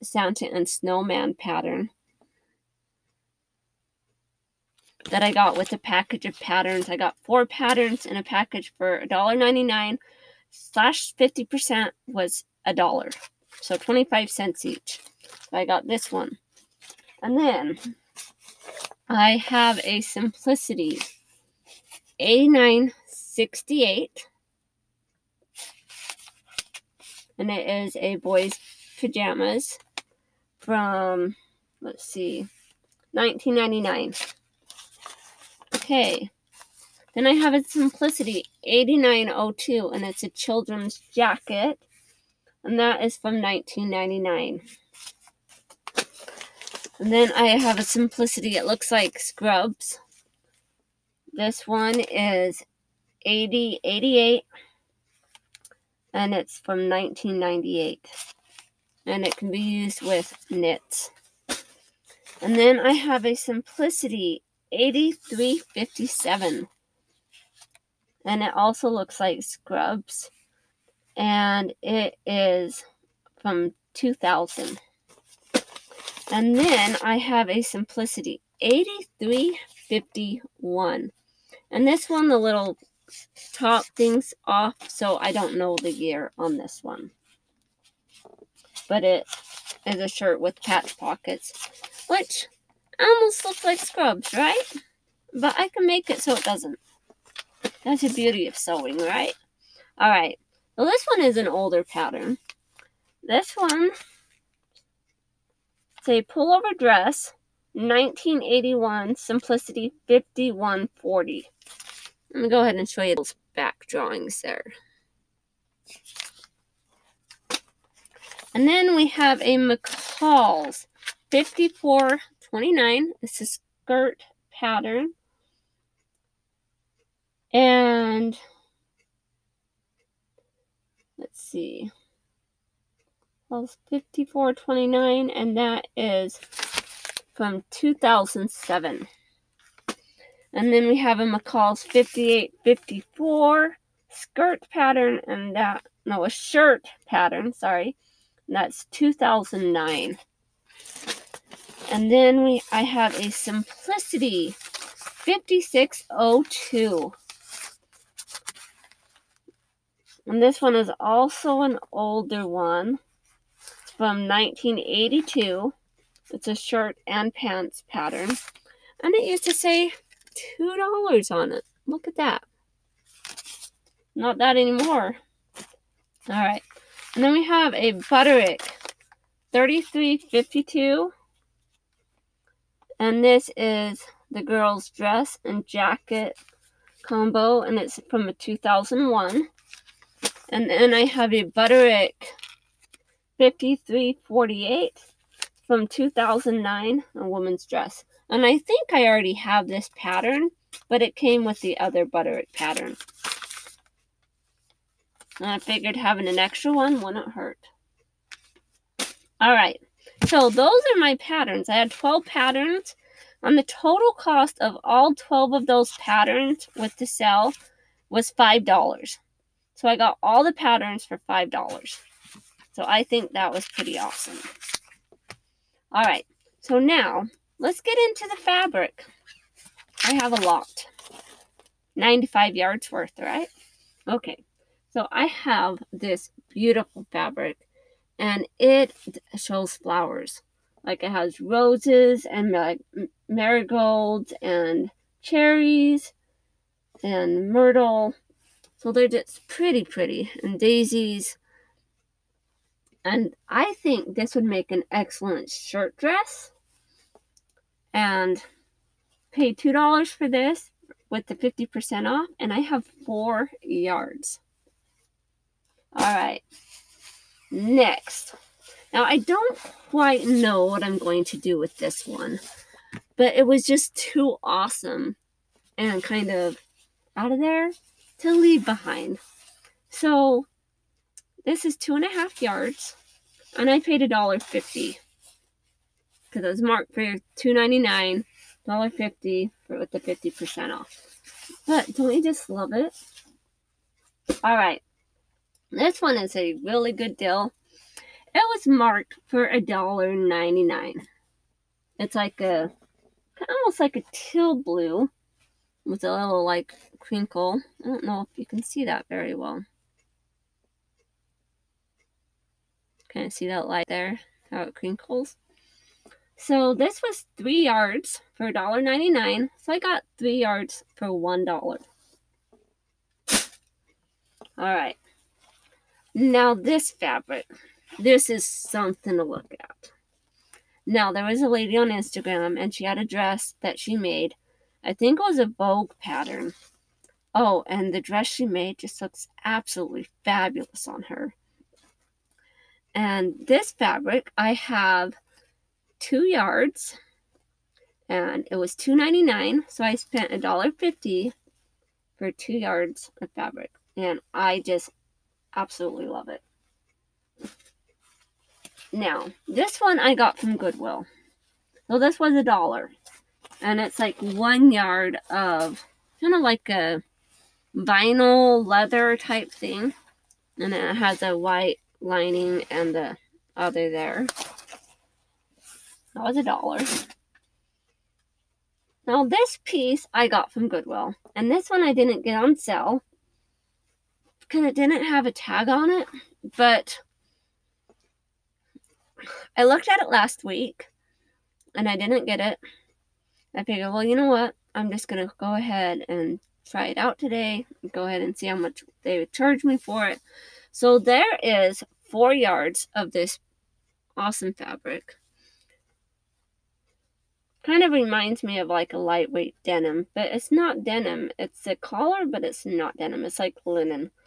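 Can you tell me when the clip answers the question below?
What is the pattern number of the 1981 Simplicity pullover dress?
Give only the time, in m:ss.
1:50.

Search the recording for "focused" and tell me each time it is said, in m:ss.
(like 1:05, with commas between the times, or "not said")
not said.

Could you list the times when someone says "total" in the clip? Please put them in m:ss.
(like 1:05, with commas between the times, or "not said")
3:33.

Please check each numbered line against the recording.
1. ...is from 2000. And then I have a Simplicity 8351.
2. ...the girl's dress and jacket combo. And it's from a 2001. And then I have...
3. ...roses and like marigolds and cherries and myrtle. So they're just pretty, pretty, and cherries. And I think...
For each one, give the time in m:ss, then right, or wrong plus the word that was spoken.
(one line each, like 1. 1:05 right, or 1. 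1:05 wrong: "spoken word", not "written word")
1. 1:12 right
2. 3:04 right
3. 4:01 wrong: "daisies", not "cherries".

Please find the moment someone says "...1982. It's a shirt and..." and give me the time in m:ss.
2:44.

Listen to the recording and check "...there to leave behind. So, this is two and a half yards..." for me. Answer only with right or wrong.
right.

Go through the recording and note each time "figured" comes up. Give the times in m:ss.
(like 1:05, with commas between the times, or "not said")
3:25, 6:33.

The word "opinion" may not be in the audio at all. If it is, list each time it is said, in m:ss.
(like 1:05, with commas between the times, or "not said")
not said.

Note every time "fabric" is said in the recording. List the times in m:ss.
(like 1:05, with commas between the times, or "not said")
3:48, 3:57, 5:26, 5:43, 5:53, 6:44.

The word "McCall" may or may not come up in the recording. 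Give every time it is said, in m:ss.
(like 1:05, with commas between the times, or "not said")
1:59, 2:13, 2:21.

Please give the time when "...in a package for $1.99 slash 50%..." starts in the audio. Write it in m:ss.
0:08.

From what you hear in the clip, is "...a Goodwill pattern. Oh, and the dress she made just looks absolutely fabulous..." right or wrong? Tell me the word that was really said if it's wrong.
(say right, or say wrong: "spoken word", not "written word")
wrong: "Vogue", not "Goodwill".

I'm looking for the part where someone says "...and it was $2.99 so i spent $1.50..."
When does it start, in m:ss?
5:48.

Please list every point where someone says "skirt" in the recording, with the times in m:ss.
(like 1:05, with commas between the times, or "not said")
2:03, 2:24.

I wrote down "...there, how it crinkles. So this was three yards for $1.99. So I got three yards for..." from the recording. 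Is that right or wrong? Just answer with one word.
right.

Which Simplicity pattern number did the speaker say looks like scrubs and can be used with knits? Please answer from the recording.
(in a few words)
8088.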